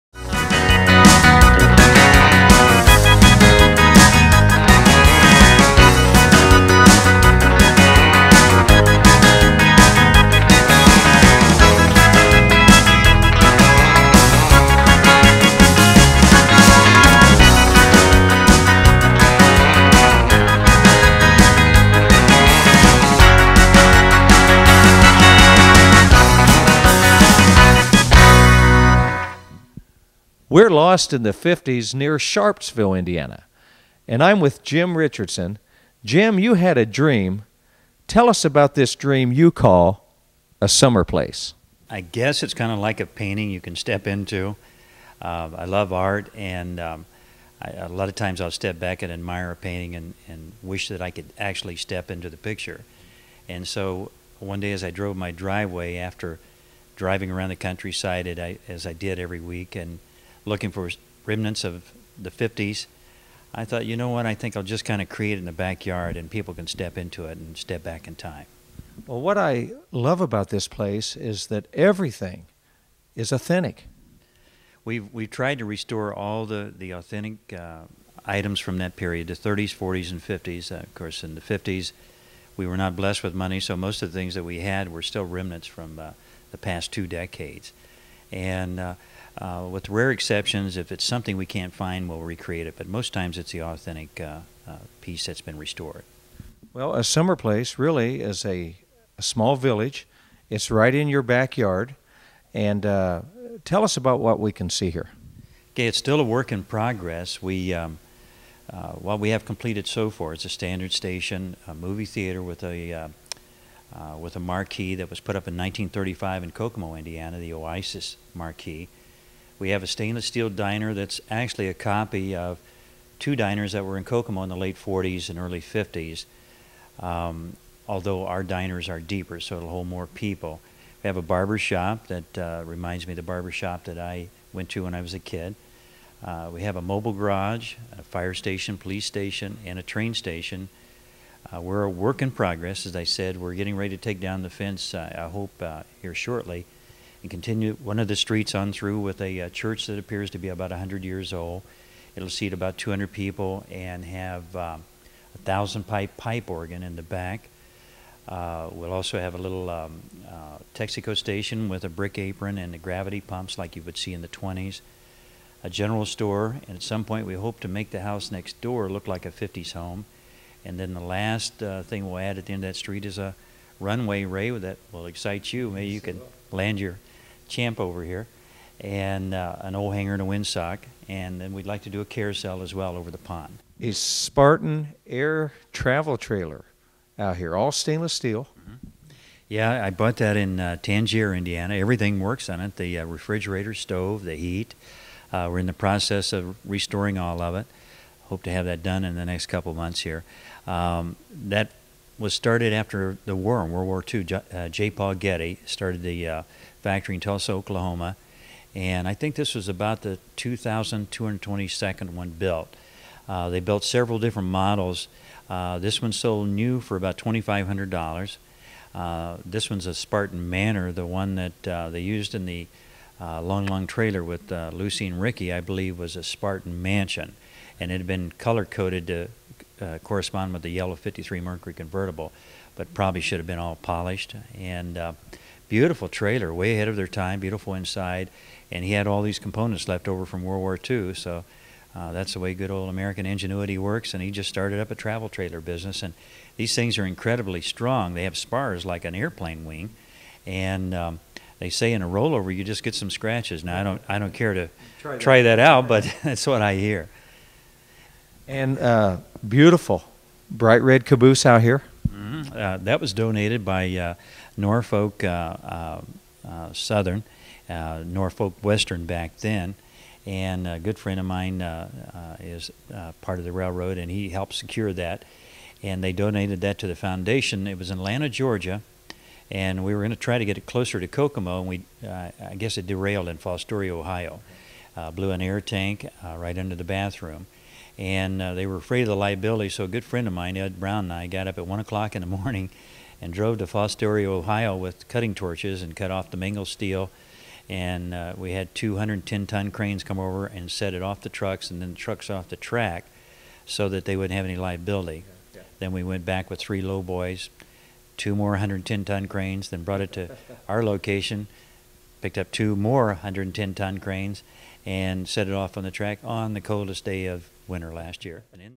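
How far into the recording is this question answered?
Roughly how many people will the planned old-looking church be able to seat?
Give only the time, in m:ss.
2:32.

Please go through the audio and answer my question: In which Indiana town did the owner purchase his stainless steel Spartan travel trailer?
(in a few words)
Tangier, Indiana.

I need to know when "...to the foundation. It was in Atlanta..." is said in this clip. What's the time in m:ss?
4:36.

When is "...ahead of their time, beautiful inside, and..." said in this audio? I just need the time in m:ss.
3:56.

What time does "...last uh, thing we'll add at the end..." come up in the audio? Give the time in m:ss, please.
2:50.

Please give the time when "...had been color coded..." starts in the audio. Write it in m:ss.
3:47.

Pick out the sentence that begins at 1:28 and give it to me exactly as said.
And uh, uh, with rare exceptions, if it's something we can't find, we'll recreate it.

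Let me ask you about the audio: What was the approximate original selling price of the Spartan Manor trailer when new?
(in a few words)
$2,500.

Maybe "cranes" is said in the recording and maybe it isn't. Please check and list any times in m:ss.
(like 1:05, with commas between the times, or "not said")
4:59, 5:09, 5:13.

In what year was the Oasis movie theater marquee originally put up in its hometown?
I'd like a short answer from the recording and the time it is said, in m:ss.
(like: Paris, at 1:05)
1935, at 1:55.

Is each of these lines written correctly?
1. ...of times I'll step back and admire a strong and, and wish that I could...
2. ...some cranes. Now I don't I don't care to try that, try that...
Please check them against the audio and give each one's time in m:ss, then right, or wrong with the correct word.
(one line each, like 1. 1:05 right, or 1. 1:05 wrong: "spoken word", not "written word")
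1. 0:48 wrong: "painting", not "strong"
2. 4:12 wrong: "scratches", not "cranes".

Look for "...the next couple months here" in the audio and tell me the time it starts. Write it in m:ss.
3:19.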